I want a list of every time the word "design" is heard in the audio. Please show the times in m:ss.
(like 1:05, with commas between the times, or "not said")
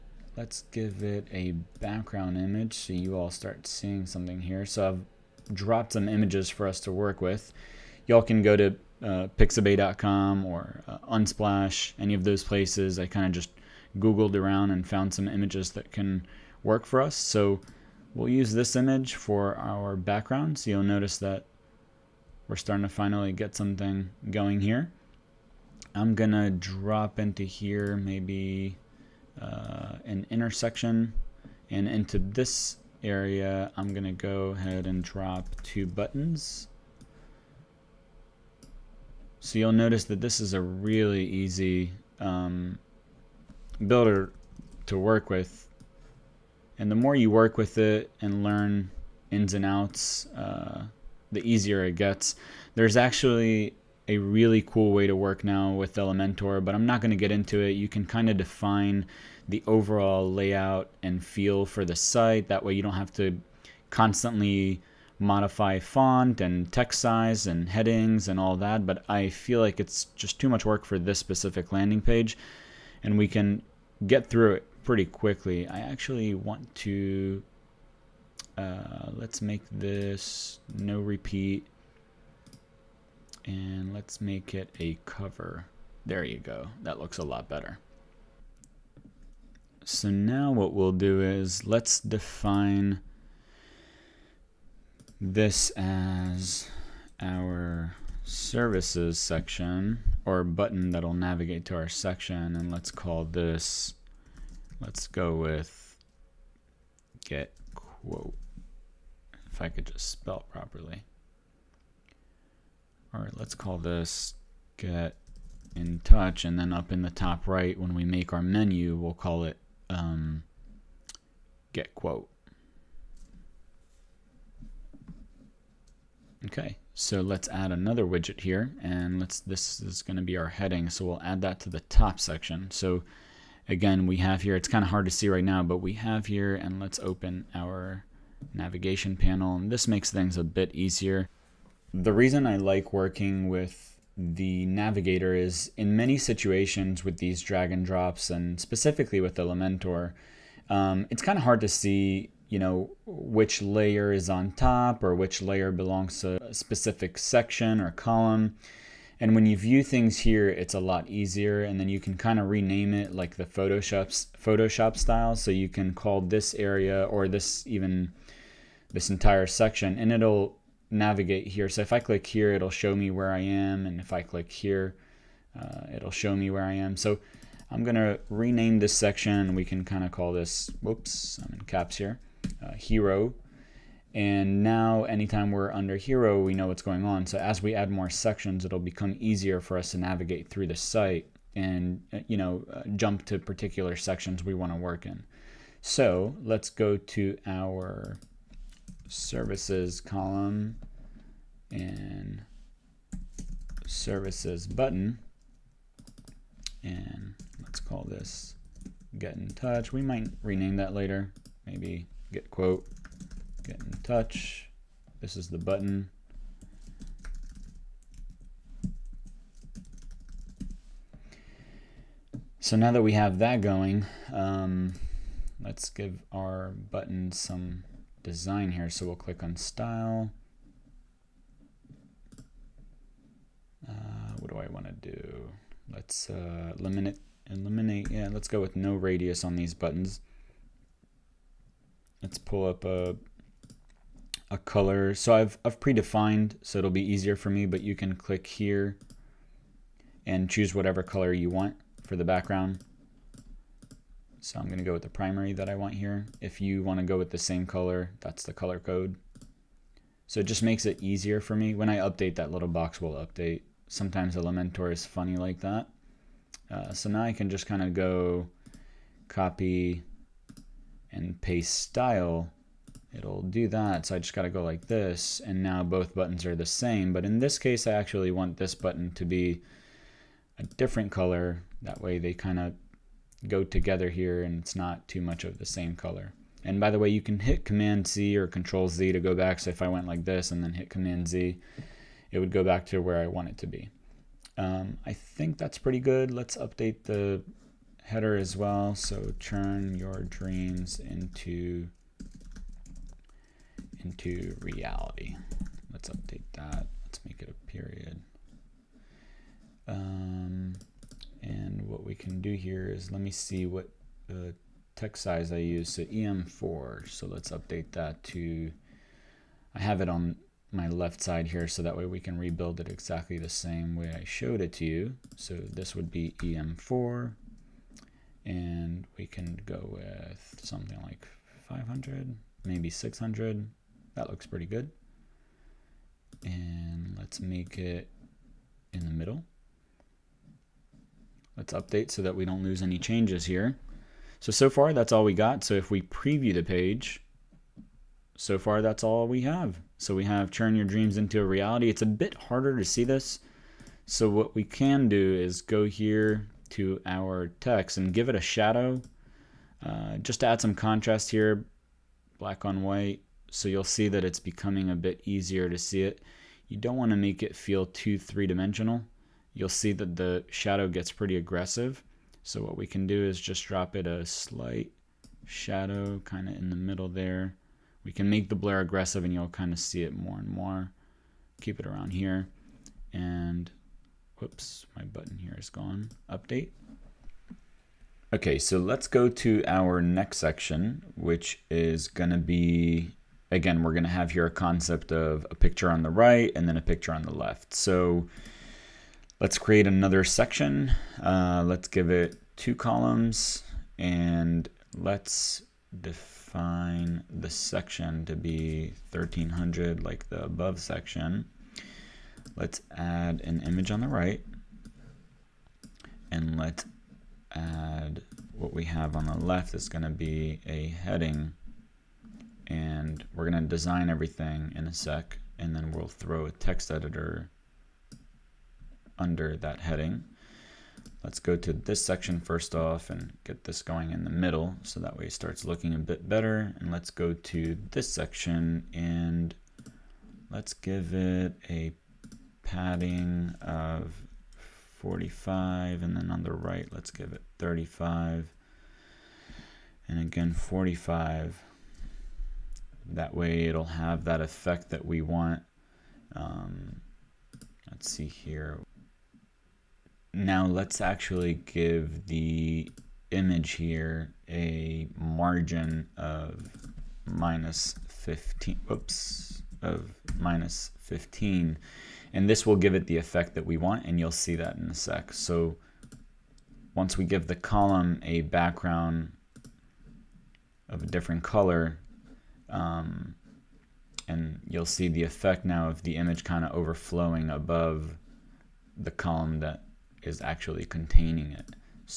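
3:48, 7:03.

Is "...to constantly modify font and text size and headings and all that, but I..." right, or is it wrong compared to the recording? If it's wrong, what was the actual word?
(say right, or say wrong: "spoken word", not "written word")
right.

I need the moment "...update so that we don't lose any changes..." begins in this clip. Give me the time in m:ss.
5:41.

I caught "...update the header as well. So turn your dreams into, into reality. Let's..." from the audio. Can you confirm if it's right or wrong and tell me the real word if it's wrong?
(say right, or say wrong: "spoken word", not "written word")
right.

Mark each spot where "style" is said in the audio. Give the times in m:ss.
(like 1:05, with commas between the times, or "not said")
2:44, 3:49, 4:31.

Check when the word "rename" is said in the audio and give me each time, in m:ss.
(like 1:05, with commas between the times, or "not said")
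2:42, 2:58, 3:30.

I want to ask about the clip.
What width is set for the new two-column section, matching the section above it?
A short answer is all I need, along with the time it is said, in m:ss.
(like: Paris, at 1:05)
1300, at 6:49.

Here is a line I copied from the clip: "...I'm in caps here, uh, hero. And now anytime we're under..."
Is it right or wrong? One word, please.
right.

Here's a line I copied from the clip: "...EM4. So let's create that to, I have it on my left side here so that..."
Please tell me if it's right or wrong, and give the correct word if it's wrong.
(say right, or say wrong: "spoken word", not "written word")
wrong: "update", not "create".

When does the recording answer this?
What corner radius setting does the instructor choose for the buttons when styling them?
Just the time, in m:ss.
3:58.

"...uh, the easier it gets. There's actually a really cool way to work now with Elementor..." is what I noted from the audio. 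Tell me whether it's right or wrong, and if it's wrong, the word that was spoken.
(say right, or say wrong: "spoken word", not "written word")
right.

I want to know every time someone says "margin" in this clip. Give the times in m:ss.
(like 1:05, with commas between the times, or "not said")
7:45.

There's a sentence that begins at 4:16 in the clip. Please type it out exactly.
If you want to go with the same color, that's the color code.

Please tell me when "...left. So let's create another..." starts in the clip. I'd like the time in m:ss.
6:37.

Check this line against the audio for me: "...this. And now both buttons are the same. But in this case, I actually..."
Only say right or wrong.
right.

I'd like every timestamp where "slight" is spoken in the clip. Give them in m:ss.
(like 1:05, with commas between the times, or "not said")
6:14.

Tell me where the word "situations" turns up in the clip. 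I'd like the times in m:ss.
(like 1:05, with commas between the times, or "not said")
2:26.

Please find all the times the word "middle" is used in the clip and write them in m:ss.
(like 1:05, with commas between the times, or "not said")
5:39, 6:16, 7:14.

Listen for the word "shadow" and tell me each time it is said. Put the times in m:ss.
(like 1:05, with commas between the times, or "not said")
5:58, 6:10, 6:15.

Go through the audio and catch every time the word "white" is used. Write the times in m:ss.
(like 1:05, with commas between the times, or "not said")
6:02.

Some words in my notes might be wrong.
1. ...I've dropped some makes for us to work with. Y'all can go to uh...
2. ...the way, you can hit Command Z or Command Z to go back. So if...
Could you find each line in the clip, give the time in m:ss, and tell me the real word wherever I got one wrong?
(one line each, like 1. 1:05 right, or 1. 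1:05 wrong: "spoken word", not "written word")
1. 0:04 wrong: "images", not "makes"
2. 4:46 wrong: "Control", not "Command".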